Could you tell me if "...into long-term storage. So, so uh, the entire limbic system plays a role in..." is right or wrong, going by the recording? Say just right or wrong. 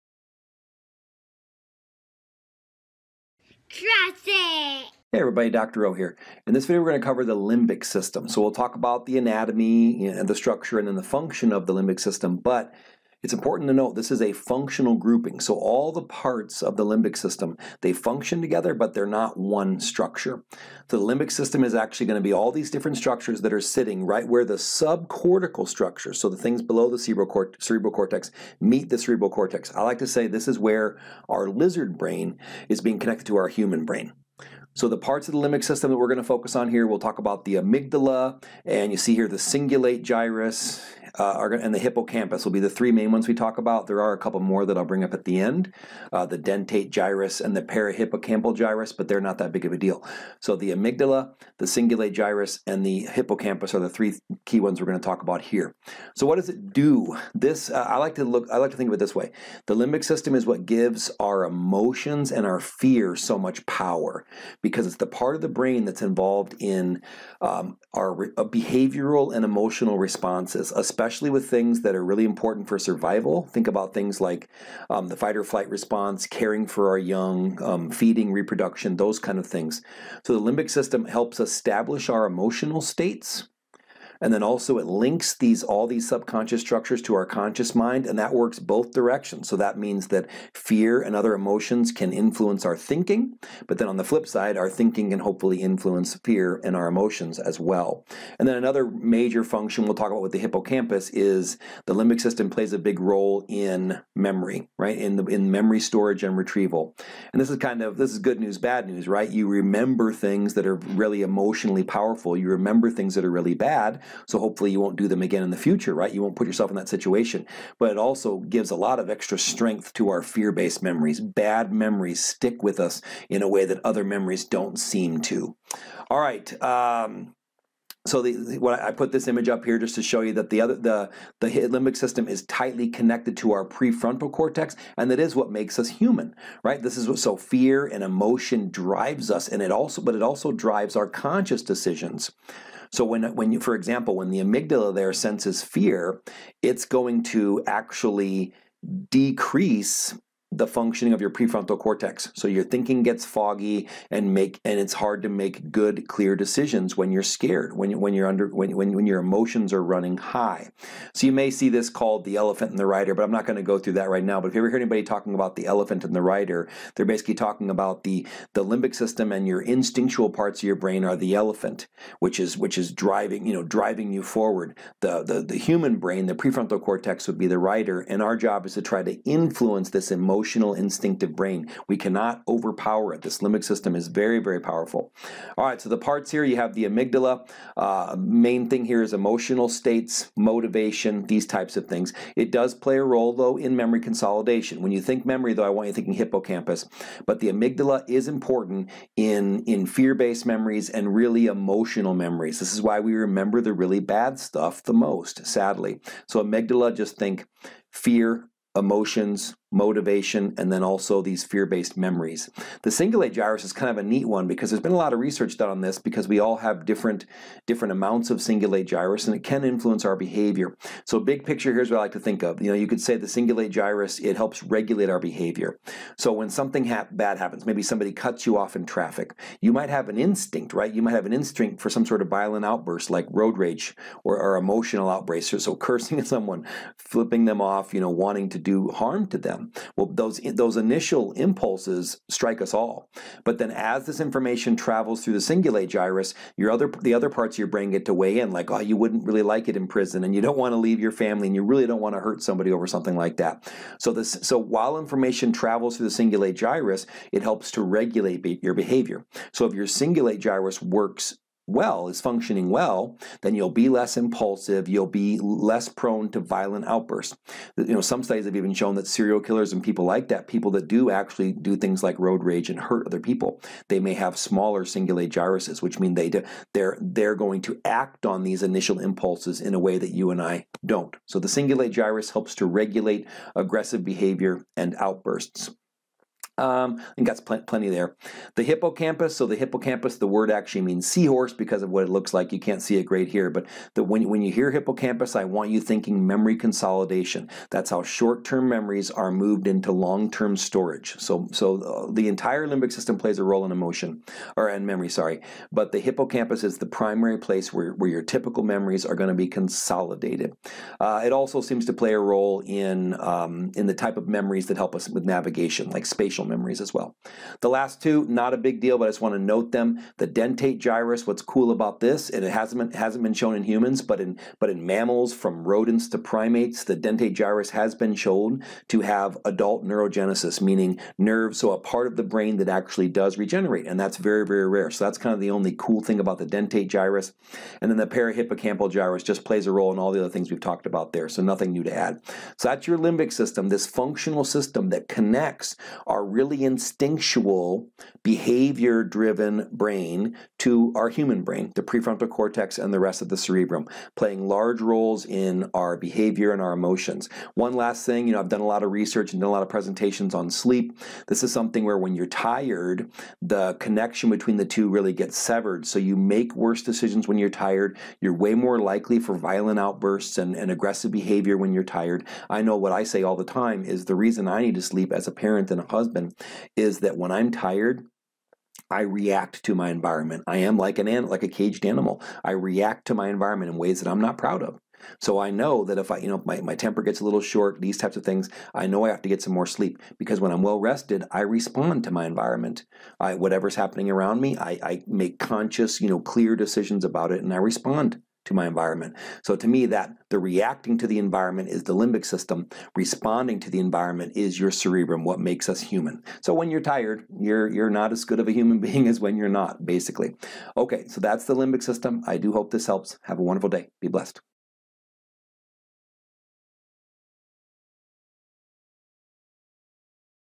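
right.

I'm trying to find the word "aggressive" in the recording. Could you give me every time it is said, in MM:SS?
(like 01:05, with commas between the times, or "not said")
04:43, 06:10.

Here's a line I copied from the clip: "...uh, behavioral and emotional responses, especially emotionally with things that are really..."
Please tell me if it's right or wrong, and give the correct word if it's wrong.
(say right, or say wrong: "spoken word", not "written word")
wrong: "especially", not "emotionally".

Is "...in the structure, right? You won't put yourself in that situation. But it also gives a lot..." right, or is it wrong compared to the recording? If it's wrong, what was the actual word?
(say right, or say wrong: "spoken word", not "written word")
wrong: "future", not "structure".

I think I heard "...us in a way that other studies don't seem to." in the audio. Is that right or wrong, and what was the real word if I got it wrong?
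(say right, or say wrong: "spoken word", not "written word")
wrong: "memories", not "studies".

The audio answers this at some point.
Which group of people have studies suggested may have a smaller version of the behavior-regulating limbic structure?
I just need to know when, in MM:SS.
04:29.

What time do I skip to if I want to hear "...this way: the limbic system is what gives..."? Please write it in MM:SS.
00:58.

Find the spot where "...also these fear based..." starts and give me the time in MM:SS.
03:30.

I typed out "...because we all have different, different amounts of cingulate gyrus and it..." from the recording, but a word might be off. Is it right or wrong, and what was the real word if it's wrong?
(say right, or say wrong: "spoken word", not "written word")
right.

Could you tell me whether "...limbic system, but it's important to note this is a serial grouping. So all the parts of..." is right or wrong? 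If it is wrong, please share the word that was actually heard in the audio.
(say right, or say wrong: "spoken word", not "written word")
wrong: "functional", not "serial".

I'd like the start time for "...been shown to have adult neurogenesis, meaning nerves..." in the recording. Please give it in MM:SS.
05:27.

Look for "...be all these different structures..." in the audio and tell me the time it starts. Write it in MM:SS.
00:22.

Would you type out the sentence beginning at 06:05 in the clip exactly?
So you make worse decisions when you're tired.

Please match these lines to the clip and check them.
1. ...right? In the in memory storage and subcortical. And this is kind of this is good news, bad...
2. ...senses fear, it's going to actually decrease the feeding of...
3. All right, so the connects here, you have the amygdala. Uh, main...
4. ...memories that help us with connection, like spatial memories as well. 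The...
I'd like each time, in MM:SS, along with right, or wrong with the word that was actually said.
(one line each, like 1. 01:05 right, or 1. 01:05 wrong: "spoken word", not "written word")
1. 01:44 wrong: "retrieval", not "subcortical"
2. 02:25 wrong: "functioning", not "feeding"
3. 03:05 wrong: "parts", not "connects"
4. 05:14 wrong: "navigation", not "connection".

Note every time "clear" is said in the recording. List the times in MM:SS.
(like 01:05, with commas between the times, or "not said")
02:36, 06:36.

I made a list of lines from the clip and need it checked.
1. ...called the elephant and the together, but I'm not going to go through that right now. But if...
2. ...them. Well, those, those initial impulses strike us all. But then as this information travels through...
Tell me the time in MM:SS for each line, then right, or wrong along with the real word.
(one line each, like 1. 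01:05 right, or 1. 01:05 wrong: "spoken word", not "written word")
1. 02:41 wrong: "rider", not "together"
2. 03:59 right.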